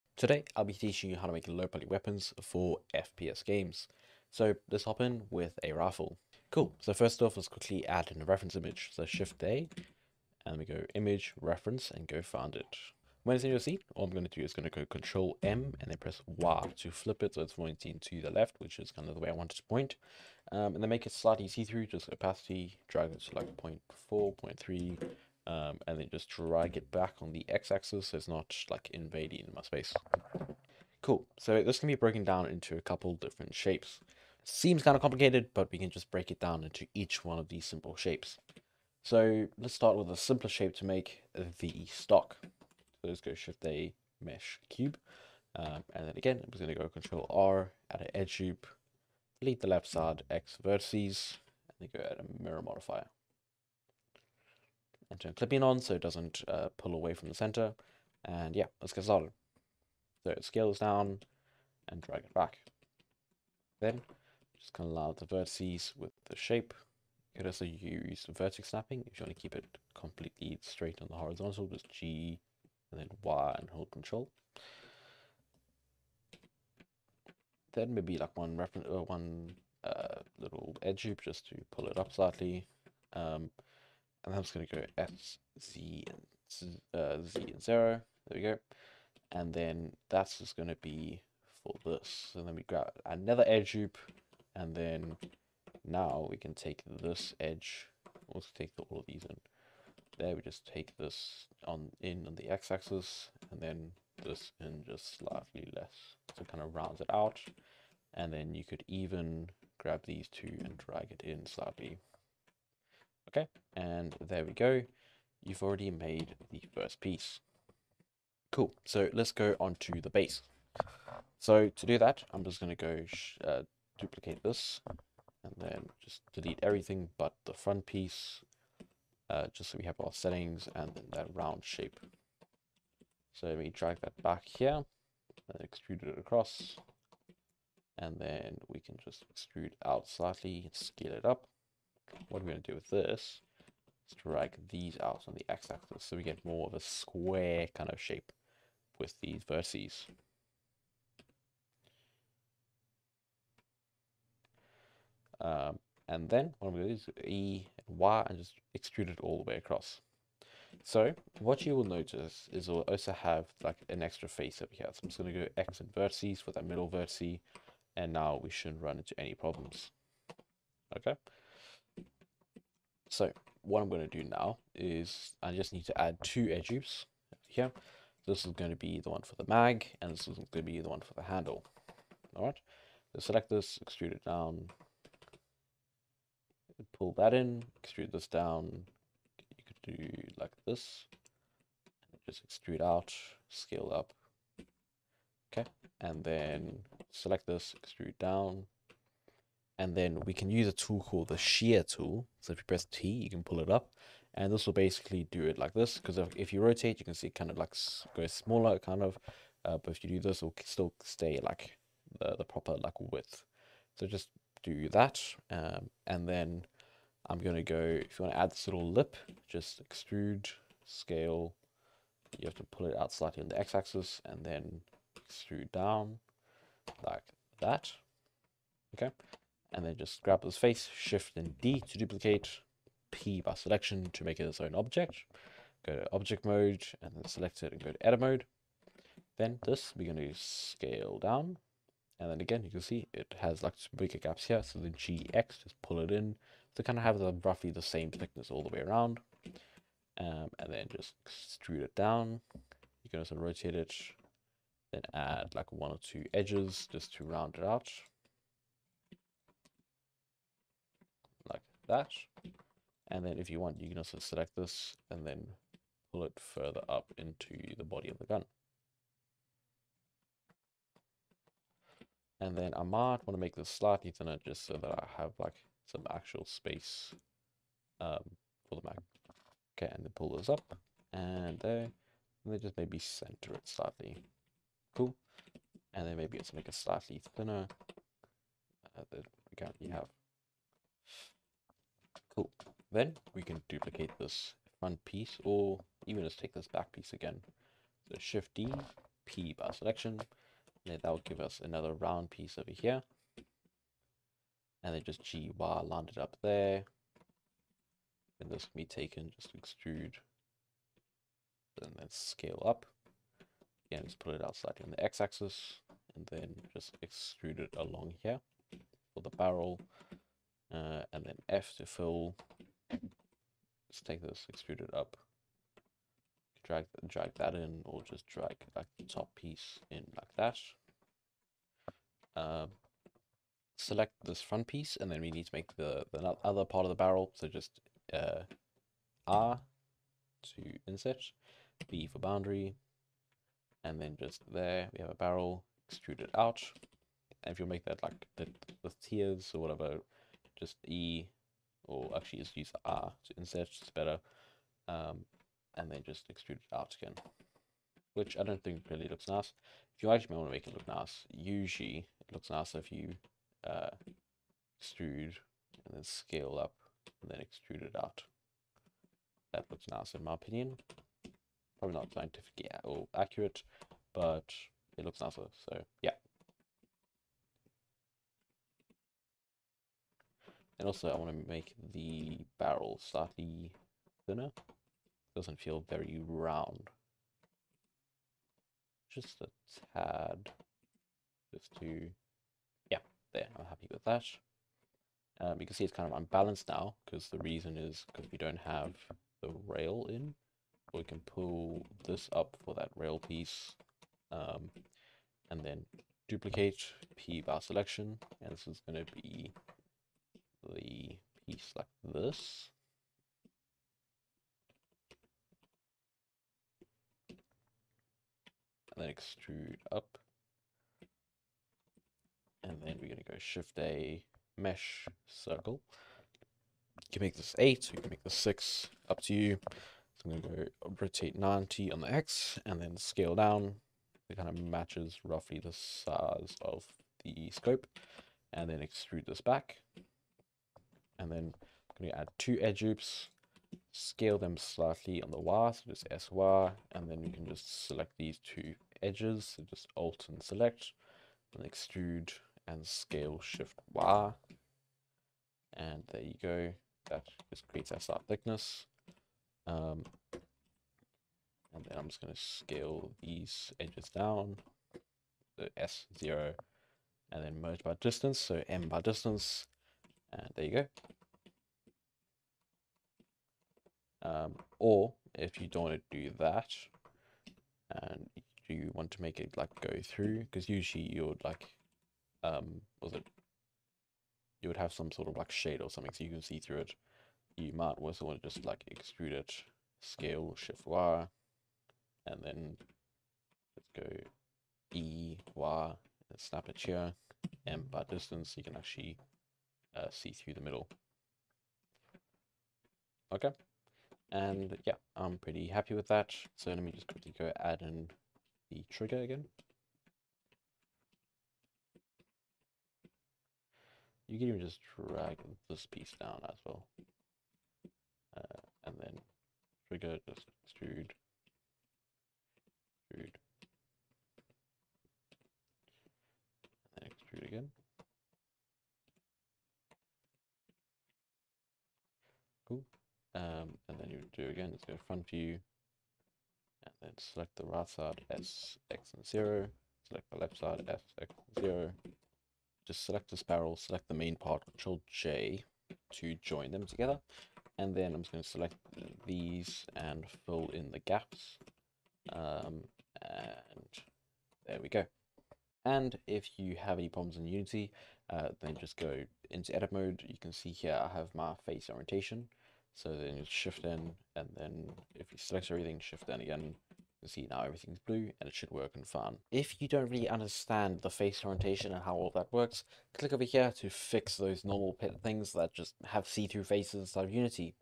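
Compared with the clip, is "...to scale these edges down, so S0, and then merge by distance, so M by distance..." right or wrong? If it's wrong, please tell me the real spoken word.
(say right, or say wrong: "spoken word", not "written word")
right.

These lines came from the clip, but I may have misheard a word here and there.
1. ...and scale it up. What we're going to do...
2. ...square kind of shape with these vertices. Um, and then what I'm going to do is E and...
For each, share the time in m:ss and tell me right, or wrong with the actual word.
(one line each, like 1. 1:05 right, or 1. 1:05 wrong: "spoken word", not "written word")
1. 2:20 right
2. 2:26 right.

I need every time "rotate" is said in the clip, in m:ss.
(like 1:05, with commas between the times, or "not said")
3:26, 4:13, 7:11.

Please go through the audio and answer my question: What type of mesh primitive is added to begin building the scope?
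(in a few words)
Circle.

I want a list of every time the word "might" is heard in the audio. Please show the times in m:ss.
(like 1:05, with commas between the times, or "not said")
4:32, 8:07.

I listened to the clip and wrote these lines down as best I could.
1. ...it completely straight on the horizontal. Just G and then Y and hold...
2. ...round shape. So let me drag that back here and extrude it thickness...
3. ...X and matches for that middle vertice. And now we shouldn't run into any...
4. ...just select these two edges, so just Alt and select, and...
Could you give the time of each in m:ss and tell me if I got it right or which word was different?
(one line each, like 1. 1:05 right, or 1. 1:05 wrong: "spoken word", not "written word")
1. 1:09 right
2. 2:11 wrong: "across", not "thickness"
3. 2:45 wrong: "vertices", not "matches"
4. 7:27 right.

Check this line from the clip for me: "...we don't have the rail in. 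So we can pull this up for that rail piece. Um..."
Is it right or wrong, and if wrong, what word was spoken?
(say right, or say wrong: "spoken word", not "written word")
right.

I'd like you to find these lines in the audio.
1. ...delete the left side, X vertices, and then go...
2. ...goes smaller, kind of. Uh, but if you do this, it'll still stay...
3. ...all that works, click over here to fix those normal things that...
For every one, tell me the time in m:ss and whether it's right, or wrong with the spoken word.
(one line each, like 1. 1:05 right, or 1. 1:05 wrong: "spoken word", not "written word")
1. 0:49 right
2. 3:28 right
3. 9:32 right.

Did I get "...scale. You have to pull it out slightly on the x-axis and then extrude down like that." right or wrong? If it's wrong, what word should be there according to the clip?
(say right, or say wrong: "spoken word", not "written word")
right.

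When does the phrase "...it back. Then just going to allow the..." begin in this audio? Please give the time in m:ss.
1:02.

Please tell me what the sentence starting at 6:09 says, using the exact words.
That looks nice in my opinion.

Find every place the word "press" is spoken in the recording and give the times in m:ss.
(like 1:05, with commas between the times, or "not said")
0:15, 3:22.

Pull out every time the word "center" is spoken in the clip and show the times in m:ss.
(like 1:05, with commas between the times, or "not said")
0:57, 4:42.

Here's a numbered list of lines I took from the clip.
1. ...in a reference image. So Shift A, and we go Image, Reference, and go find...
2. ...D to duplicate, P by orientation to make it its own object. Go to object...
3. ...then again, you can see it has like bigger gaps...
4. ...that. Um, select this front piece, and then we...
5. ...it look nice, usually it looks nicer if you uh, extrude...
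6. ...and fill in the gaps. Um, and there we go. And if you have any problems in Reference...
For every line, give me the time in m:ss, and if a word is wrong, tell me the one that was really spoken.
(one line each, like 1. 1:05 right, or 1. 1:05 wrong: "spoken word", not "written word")
1. 0:08 right
2. 3:51 wrong: "selection", not "orientation"
3. 4:02 right
4. 5:30 right
5. 6:00 right
6. 9:09 wrong: "Unity", not "Reference".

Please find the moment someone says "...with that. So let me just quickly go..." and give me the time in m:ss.
8:25.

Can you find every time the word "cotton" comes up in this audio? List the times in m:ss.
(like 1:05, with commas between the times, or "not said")
not said.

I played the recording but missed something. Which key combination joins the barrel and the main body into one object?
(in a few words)
Control J.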